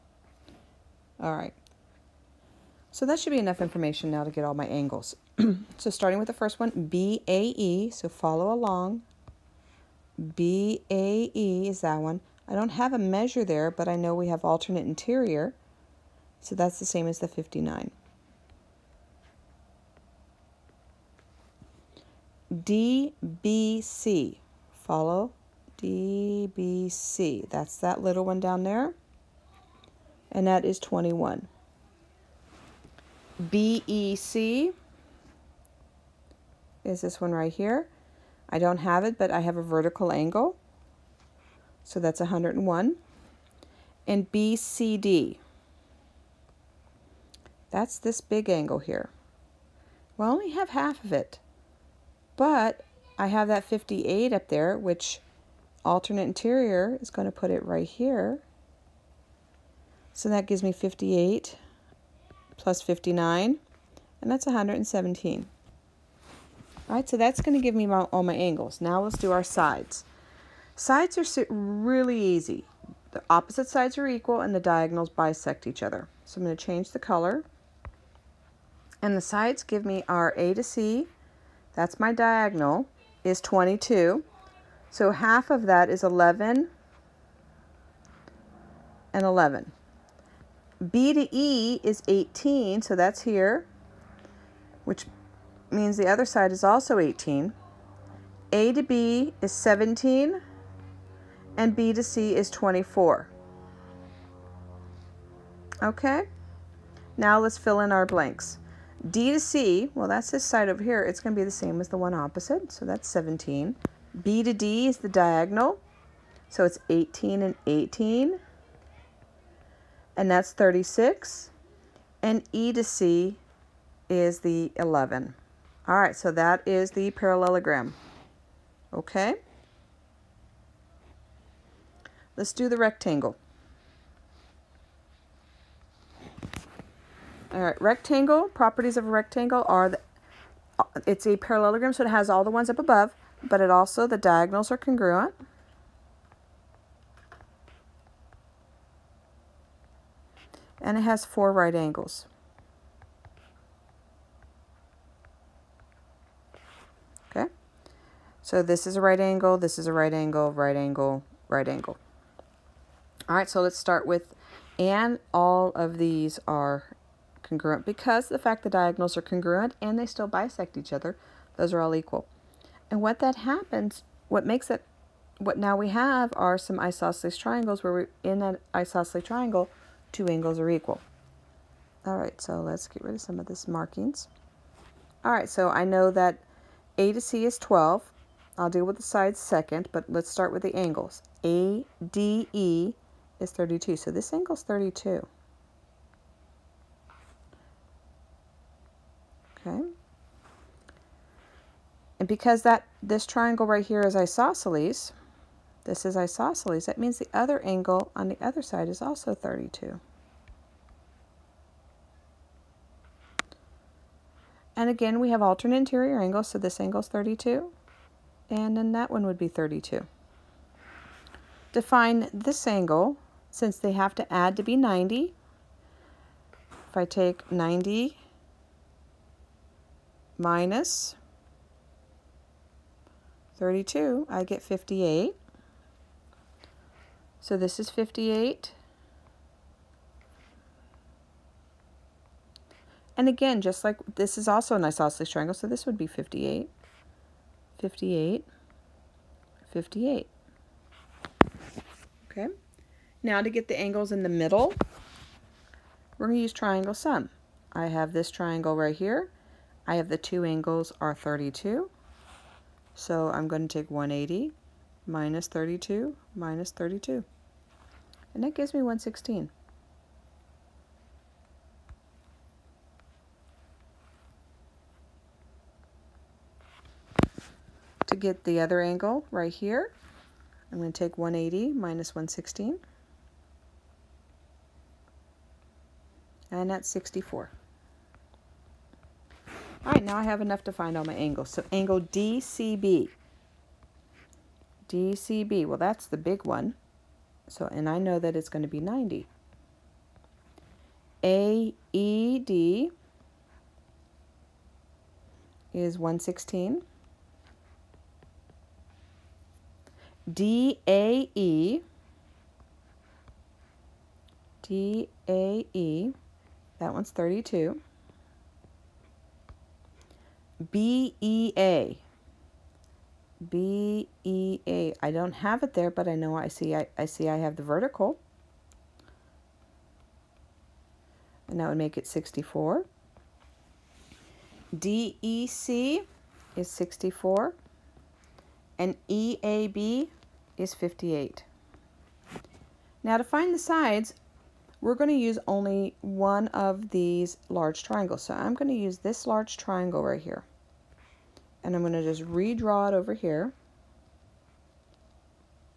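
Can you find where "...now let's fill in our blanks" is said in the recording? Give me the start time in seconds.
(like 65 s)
107 s.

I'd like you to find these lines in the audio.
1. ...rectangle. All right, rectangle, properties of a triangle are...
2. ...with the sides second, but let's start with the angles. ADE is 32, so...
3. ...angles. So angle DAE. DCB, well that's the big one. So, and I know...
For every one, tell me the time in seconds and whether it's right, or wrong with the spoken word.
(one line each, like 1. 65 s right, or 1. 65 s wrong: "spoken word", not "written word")
1. 132 s wrong: "rectangle", not "triangle"
2. 188 s right
3. 291 s wrong: "DCB", not "DAE".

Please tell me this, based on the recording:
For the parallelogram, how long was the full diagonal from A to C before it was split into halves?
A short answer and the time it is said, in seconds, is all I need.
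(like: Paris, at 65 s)
22, at 83 s.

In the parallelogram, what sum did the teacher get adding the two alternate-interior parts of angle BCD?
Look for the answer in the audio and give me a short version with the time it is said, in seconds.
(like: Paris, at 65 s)
117, at 64 s.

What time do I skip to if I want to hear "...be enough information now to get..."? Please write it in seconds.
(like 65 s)
3 s.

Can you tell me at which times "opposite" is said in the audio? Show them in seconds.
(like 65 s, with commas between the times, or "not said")
73 s, 112 s.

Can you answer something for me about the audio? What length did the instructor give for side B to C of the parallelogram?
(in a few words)
24.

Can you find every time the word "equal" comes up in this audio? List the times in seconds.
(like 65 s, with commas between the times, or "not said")
74 s, 171 s, 180 s.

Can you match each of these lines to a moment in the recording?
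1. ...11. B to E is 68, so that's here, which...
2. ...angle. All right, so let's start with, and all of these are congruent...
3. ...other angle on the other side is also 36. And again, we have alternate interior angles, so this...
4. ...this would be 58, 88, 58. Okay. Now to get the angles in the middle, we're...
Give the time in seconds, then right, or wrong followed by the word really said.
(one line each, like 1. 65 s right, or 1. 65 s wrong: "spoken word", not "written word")
1. 89 s wrong: "18", not "68"
2. 161 s right
3. 207 s wrong: "32", not "36"
4. 245 s wrong: "58", not "88".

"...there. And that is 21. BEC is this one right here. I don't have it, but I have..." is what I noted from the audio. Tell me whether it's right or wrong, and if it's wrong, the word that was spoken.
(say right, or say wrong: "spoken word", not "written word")
right.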